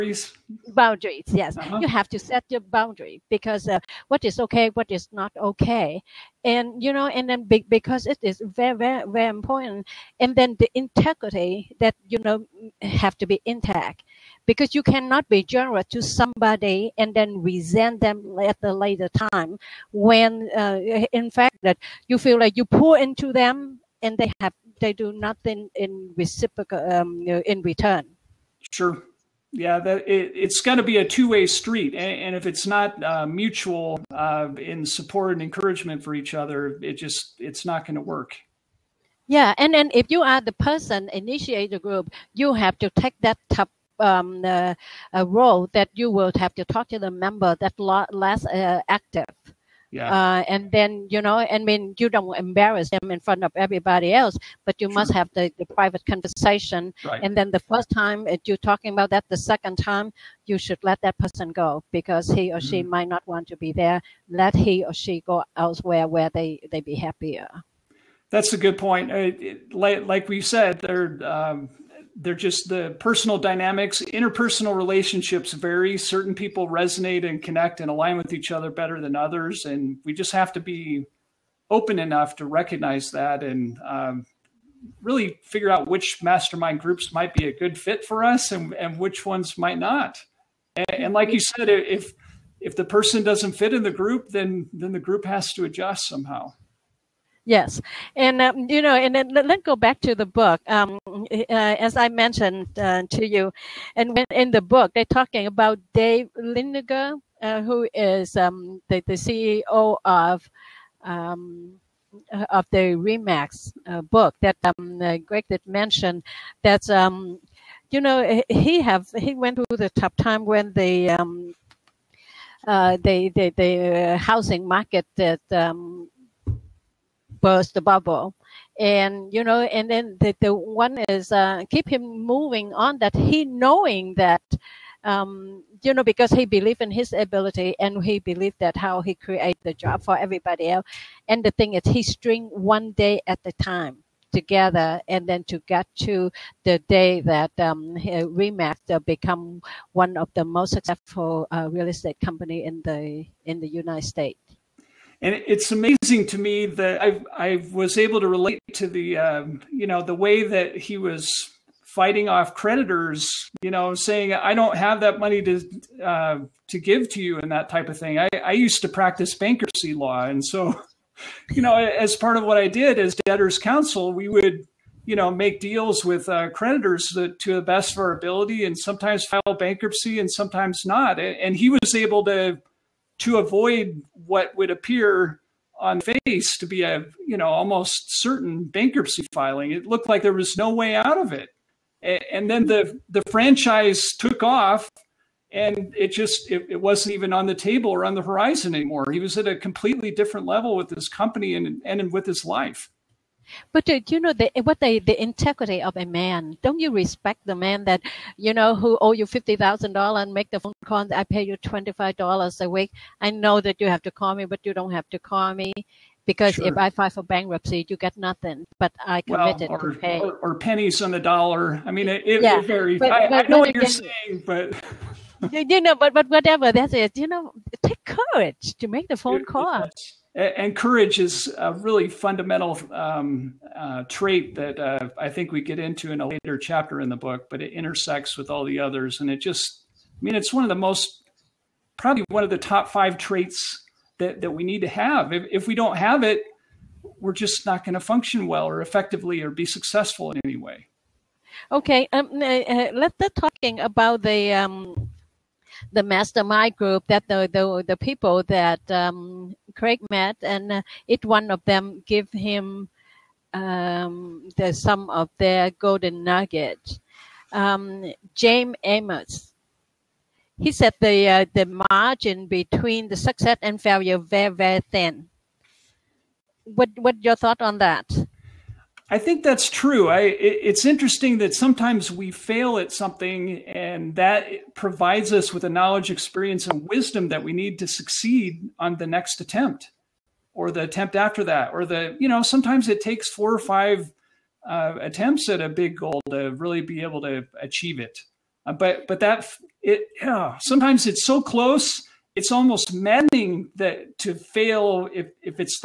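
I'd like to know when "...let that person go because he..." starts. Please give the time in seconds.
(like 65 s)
60 s.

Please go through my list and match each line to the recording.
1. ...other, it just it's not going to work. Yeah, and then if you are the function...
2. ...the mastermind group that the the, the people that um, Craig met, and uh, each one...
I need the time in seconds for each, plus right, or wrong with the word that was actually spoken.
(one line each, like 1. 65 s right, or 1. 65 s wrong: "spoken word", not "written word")
1. 36 s wrong: "person", not "function"
2. 255 s right.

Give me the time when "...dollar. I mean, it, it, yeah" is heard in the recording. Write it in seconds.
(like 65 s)
221 s.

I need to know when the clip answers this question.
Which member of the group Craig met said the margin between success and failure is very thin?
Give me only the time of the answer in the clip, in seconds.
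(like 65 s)
268 s.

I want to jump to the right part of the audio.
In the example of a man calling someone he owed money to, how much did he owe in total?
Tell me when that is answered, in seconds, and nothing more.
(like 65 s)
209 s.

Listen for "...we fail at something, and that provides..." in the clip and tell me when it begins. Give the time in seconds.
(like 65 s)
282 s.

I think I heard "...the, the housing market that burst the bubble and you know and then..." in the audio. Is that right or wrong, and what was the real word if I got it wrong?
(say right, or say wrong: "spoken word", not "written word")
right.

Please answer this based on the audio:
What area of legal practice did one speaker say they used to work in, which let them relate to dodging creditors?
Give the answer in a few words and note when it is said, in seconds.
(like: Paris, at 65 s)
Bankruptcy law, at 169 s.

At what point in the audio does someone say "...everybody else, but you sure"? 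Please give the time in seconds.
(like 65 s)
53 s.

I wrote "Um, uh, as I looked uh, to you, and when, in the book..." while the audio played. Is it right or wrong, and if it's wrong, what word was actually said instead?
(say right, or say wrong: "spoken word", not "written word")
wrong: "mentioned", not "looked".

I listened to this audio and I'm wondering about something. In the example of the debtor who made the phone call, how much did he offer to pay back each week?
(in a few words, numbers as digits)
$25.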